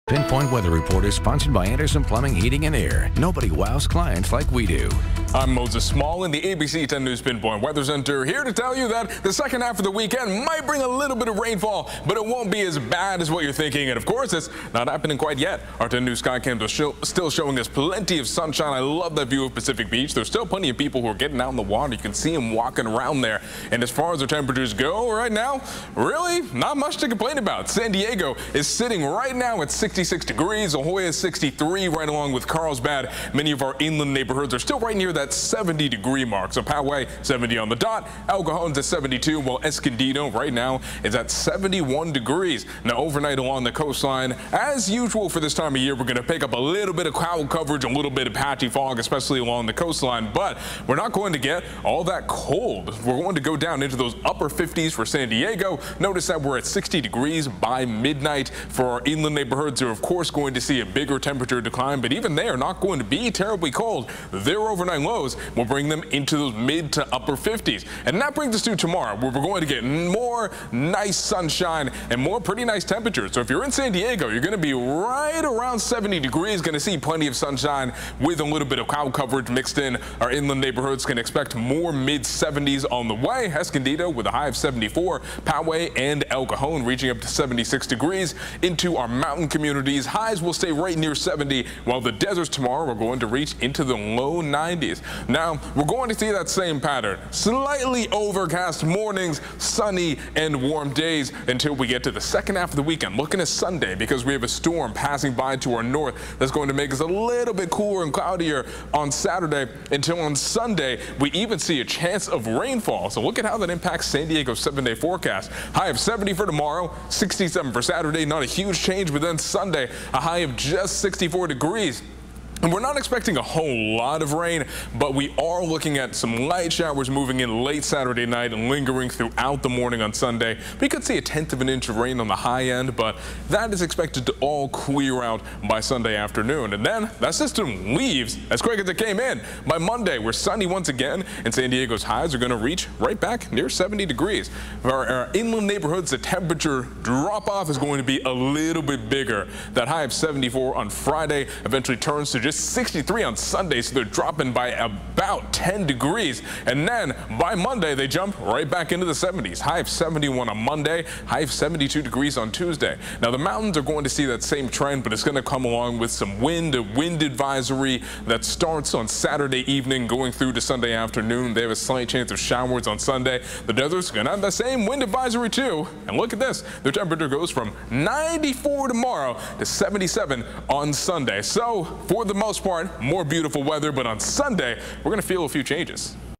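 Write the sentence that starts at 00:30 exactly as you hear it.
La Jolla is 63 right along with Carlsbad.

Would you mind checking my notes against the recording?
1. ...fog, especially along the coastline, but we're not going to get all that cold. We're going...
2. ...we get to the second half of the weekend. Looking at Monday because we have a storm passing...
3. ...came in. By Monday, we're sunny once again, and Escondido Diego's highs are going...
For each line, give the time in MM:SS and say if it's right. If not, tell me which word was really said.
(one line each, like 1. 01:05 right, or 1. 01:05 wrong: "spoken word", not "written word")
1. 00:48 right
2. 01:41 wrong: "Sunday", not "Monday"
3. 02:18 wrong: "San", not "Escondido".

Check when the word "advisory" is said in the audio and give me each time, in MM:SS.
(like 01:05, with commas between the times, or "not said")
02:47, 02:55.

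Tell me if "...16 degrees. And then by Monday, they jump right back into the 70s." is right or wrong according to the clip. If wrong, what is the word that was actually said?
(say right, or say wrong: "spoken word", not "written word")
wrong: "10", not "16".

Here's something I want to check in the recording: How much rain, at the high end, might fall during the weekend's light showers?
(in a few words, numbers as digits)
a tenth of an inch.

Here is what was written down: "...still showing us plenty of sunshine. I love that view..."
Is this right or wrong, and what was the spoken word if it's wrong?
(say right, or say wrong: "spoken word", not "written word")
right.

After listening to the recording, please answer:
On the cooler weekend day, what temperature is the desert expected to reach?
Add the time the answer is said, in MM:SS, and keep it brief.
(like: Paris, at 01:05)
77, at 02:59.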